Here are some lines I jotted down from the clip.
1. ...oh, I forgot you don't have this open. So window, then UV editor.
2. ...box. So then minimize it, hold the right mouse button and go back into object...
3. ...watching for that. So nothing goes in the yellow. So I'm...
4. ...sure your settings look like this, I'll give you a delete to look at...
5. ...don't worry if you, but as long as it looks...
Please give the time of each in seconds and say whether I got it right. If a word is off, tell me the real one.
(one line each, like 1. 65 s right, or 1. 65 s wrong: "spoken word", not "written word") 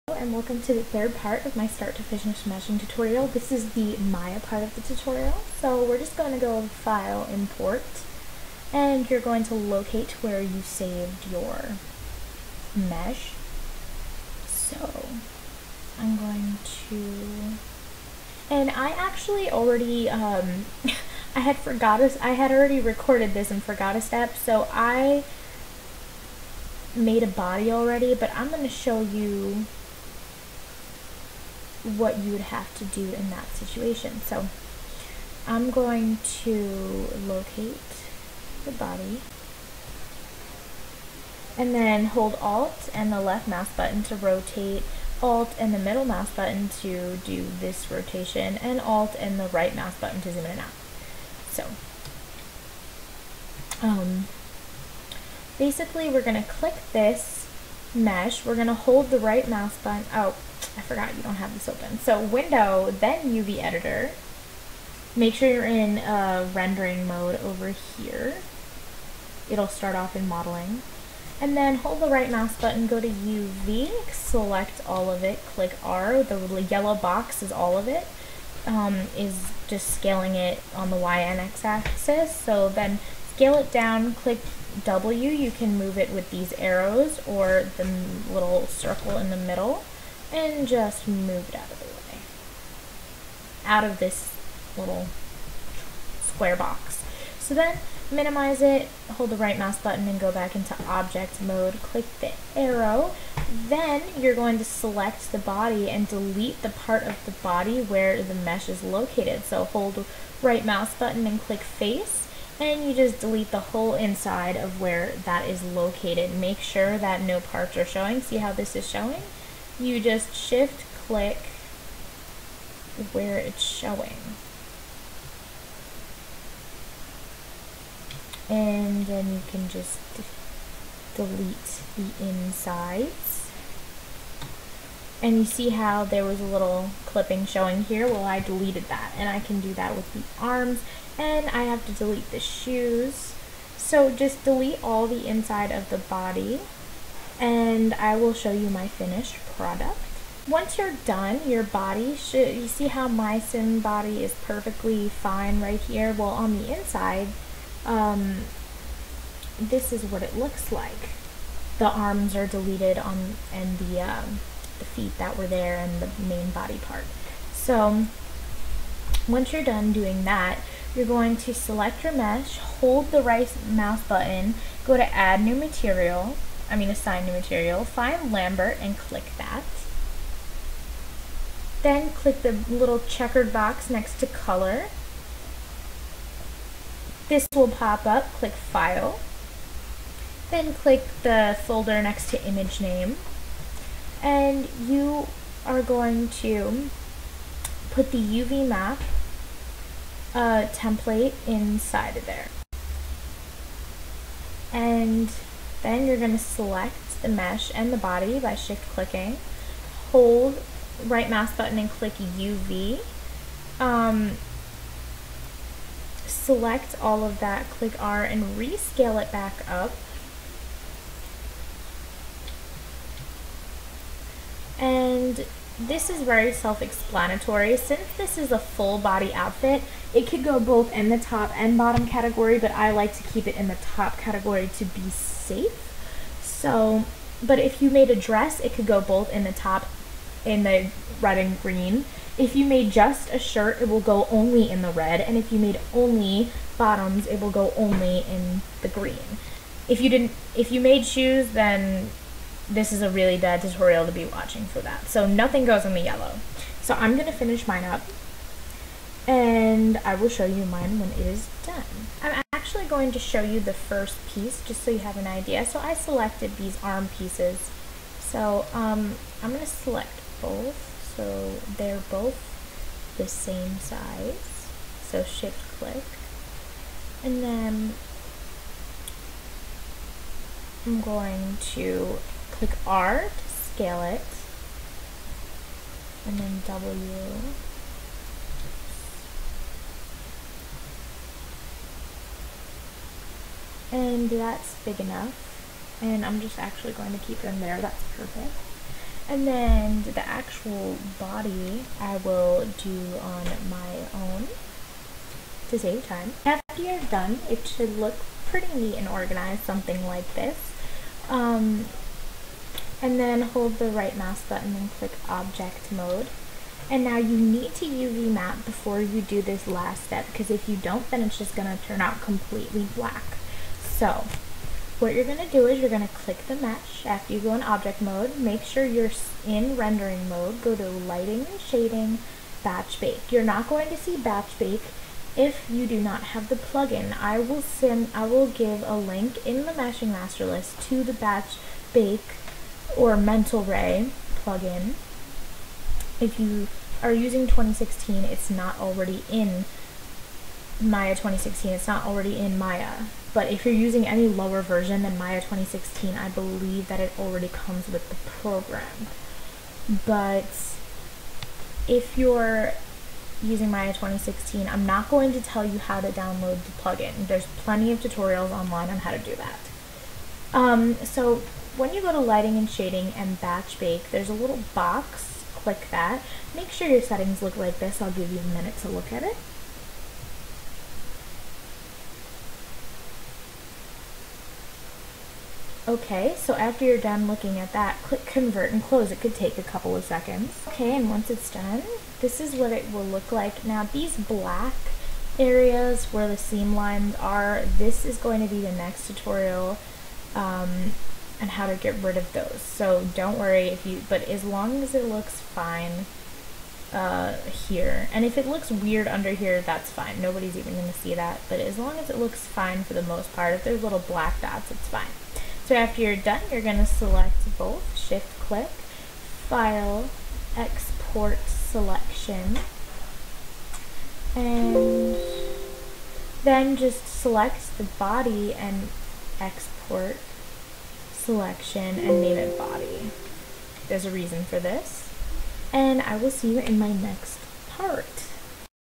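1. 60 s right
2. 96 s right
3. 254 s right
4. 376 s wrong: "minute", not "delete"
5. 403 s right.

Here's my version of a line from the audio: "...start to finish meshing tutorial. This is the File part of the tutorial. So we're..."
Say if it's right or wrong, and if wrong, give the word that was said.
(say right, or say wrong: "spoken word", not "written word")
wrong: "Maya", not "File".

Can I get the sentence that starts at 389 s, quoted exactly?
It could take a couple of seconds.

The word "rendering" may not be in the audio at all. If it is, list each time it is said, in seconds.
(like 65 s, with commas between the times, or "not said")
66 s, 329 s.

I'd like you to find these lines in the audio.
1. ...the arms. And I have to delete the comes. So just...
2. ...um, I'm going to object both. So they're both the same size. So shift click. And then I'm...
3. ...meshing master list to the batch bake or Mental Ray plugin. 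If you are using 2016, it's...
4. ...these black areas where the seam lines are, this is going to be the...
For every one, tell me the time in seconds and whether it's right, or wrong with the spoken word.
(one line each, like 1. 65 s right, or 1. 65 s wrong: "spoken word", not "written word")
1. 140 s wrong: "shoes", not "comes"
2. 268 s wrong: "select", not "object"
3. 339 s right
4. 393 s right.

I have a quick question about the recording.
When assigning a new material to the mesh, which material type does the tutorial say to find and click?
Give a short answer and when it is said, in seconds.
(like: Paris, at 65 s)
Lambert, at 178 s.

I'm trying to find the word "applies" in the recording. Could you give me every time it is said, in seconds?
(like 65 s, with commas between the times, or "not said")
not said.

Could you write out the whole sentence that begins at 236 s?
So, but if you made a dress, it could go both in the top in the red and green.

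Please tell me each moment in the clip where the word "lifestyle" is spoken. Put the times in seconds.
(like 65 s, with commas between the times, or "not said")
not said.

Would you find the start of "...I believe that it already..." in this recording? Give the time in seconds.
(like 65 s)
356 s.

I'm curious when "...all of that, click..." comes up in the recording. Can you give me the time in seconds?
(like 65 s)
217 s.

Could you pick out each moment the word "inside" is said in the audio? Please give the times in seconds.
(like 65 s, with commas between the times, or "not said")
113 s, 132 s, 145 s, 156 s, 201 s.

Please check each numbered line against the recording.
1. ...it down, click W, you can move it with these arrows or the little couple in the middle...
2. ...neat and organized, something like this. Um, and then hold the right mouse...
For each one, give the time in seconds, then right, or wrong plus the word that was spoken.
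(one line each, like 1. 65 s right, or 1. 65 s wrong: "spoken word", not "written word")
1. 83 s wrong: "circle", not "couple"
2. 308 s right.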